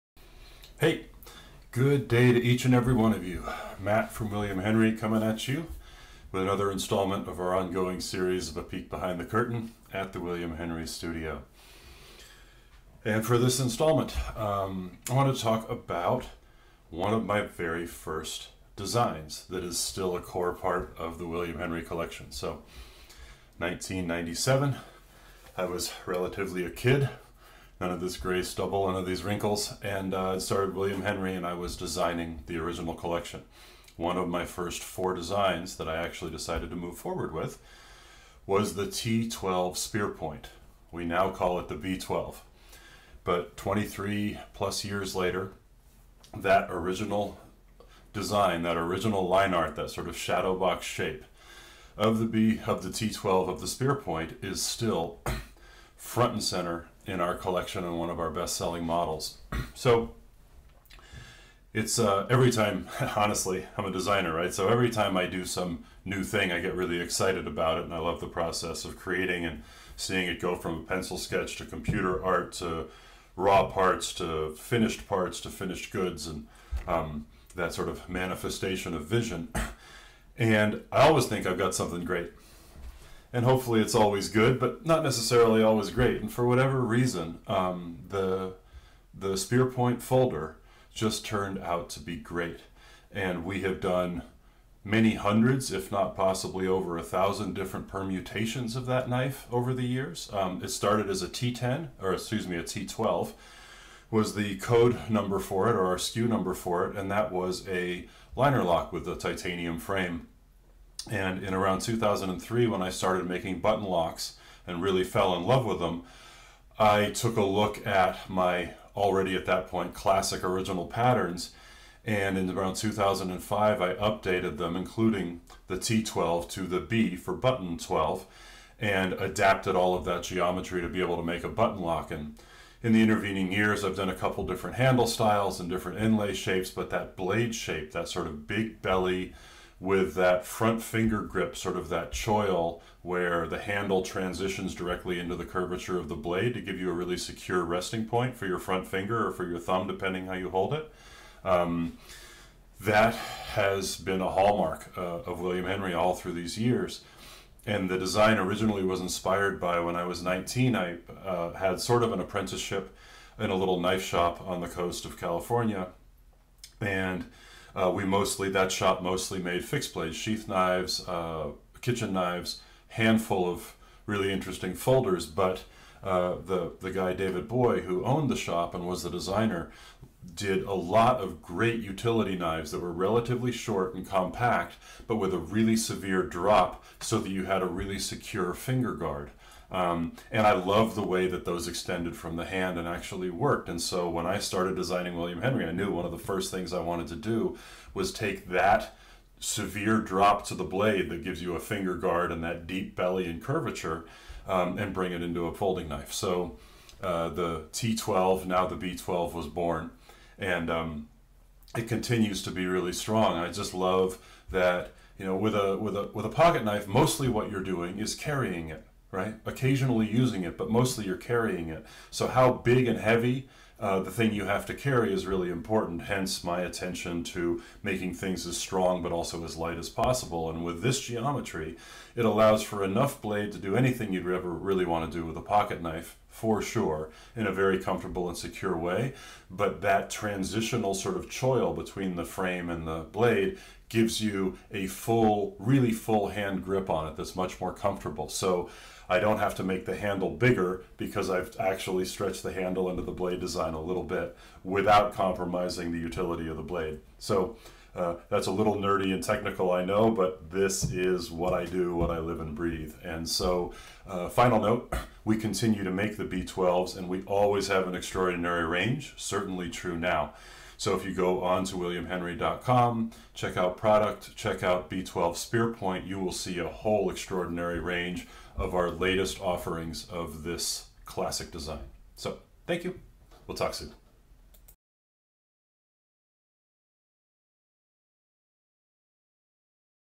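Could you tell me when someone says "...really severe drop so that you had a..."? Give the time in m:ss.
3:05.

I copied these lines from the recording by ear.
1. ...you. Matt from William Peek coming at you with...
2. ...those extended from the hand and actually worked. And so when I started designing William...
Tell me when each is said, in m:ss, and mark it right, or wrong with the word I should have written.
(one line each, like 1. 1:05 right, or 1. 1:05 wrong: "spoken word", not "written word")
1. 0:03 wrong: "Henry", not "Peek"
2. 3:11 right.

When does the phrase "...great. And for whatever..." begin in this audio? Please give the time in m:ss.
1:25.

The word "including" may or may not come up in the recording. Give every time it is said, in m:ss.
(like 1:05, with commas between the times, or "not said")
2:04.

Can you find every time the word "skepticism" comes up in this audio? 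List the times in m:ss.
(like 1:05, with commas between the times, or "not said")
not said.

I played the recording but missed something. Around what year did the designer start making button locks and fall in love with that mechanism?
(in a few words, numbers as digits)
2003.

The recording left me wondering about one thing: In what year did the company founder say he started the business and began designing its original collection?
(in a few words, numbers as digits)
1997.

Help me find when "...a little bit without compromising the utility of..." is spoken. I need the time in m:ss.
4:13.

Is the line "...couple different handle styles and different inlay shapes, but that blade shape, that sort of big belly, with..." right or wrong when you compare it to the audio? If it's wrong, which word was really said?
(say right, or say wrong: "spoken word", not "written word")
right.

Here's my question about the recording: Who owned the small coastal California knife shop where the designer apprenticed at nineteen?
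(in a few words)
David Boye.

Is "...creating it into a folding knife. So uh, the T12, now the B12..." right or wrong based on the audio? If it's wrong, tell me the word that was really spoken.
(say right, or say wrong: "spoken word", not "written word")
wrong: "bring", not "creating".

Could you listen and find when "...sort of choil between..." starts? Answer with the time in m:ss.
4:00.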